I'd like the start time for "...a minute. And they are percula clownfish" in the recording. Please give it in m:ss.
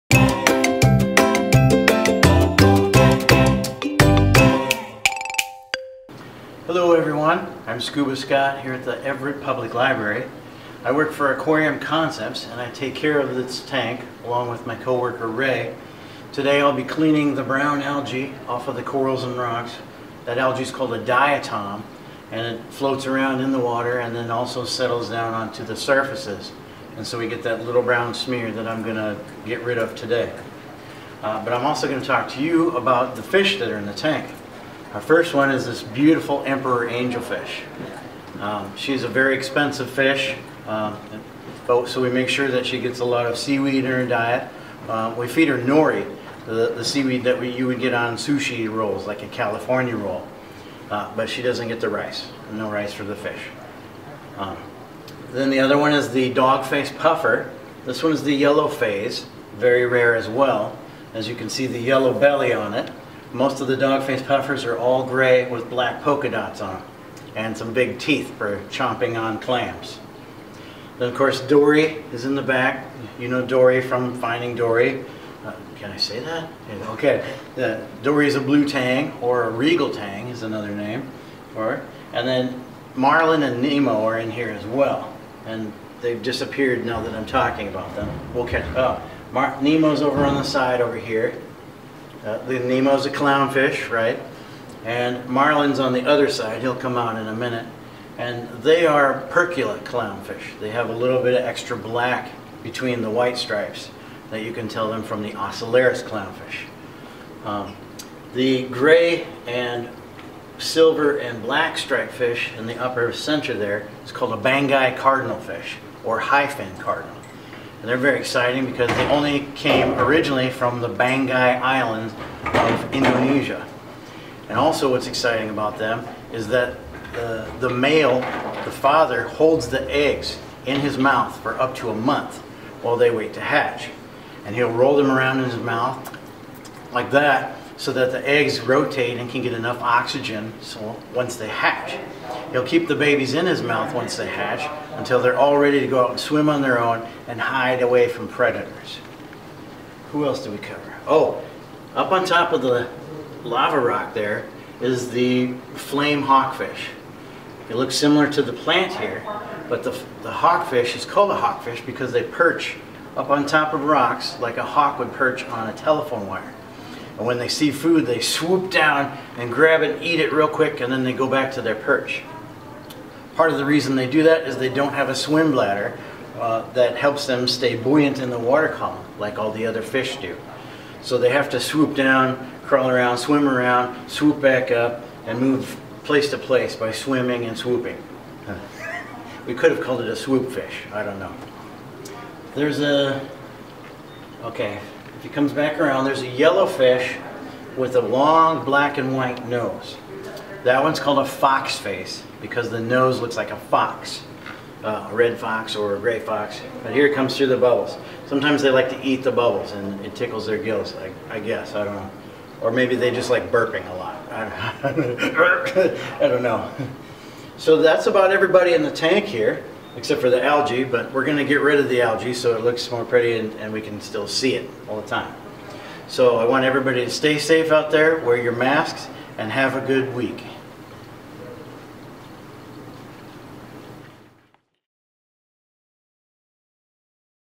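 1:37.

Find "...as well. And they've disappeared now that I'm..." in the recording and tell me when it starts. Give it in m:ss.
1:24.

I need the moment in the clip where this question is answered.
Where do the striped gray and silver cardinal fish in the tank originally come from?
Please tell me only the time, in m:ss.
2:00.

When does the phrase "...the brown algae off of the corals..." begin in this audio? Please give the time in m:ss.
0:17.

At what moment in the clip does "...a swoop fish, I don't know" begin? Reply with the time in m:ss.
3:10.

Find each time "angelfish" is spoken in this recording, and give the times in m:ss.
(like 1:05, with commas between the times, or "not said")
0:36.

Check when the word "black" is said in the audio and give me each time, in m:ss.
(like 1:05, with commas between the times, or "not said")
1:05, 1:41, 1:51, 3:18.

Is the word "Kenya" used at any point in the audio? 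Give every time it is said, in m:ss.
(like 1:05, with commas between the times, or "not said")
not said.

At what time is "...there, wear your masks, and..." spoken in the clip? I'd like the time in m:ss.
3:47.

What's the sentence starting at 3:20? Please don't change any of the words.
That one's called a fox face because the nose looks like a fox, uh, a red fox or a gray fox.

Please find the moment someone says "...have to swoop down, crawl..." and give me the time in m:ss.
3:01.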